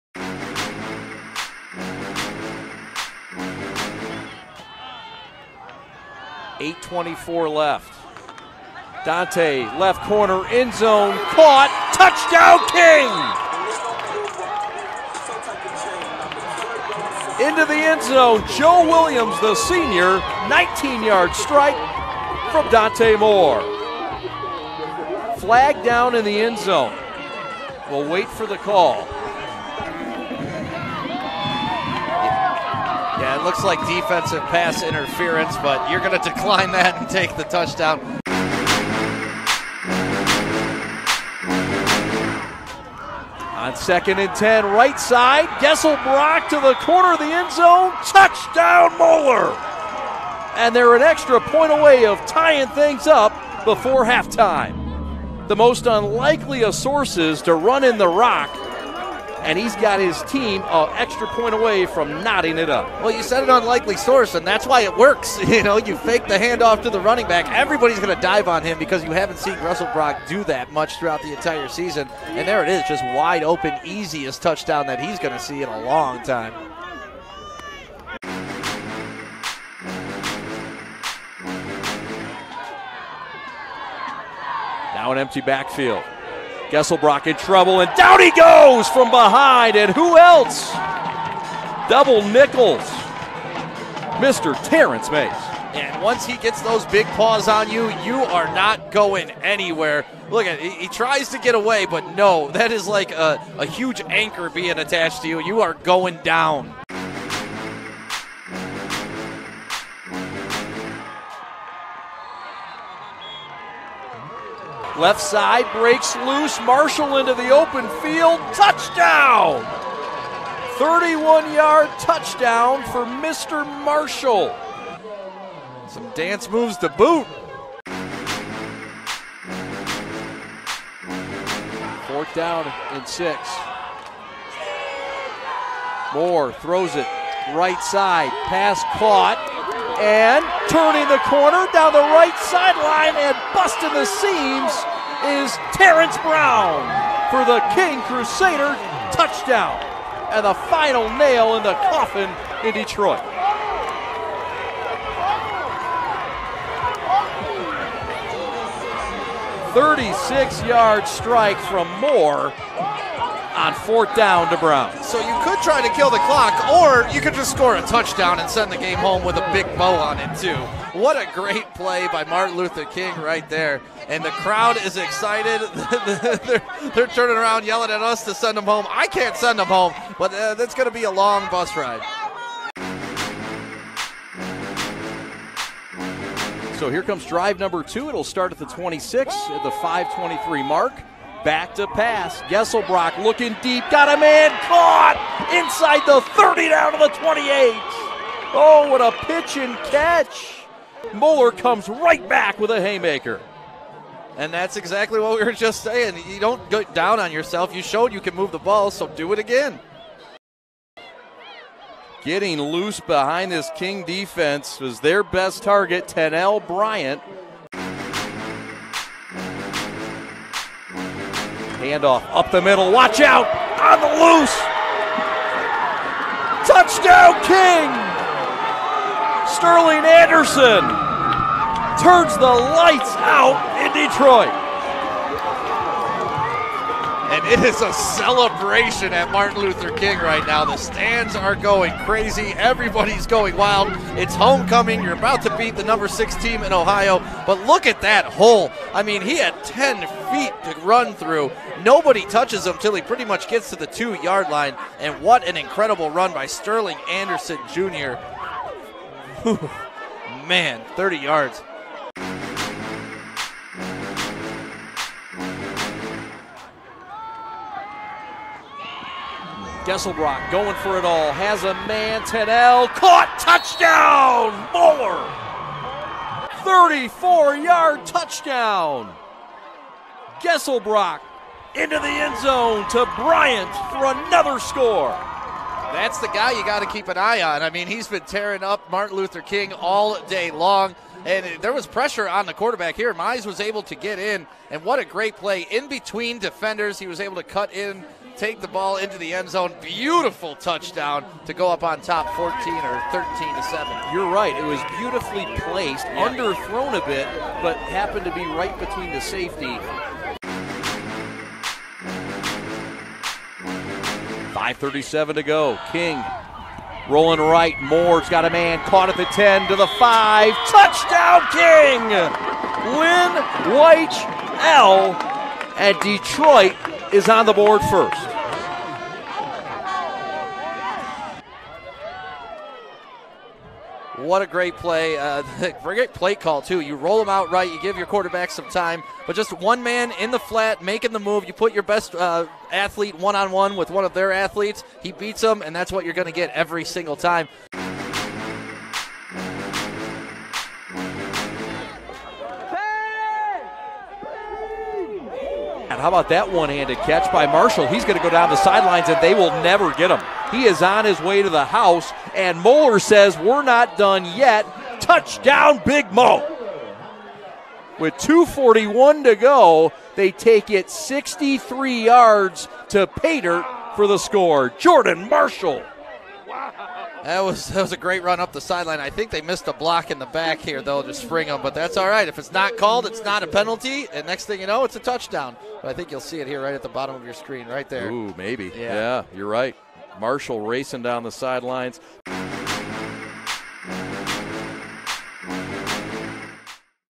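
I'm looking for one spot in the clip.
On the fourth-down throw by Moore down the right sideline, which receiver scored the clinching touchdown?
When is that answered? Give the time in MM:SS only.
02:25.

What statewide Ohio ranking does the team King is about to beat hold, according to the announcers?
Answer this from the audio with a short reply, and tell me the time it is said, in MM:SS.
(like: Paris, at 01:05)
Number 6, at 04:05.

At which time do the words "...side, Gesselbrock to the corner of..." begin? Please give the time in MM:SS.
00:44.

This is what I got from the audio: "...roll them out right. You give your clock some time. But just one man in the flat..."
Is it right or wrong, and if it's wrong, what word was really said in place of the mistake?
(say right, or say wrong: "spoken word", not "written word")
wrong: "quarterback", not "clock".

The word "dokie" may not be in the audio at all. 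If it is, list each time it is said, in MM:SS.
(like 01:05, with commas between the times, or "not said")
not said.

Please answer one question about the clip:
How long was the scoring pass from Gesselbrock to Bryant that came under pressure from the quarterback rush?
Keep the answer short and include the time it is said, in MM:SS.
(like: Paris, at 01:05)
34 yards, at 04:36.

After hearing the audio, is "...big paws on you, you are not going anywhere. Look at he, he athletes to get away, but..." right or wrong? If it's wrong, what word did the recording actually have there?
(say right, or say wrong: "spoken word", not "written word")
wrong: "tries", not "athletes".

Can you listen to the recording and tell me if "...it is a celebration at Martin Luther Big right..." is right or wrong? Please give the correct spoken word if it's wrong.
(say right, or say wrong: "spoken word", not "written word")
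wrong: "King", not "Big".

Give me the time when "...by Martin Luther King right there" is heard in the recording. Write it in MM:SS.
02:52.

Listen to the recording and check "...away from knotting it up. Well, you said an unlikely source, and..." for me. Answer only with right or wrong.
right.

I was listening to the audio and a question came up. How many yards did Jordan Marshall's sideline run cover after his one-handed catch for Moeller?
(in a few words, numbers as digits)
63.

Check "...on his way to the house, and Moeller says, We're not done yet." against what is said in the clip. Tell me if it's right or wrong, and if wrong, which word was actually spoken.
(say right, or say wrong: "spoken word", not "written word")
right.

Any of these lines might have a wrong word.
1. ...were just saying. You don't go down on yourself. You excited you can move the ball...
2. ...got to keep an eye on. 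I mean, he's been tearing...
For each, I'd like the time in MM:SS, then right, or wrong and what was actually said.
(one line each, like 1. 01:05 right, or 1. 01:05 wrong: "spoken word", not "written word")
1. 03:25 wrong: "showed", not "excited"
2. 04:46 right.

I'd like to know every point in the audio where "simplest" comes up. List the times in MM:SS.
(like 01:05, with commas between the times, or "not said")
not said.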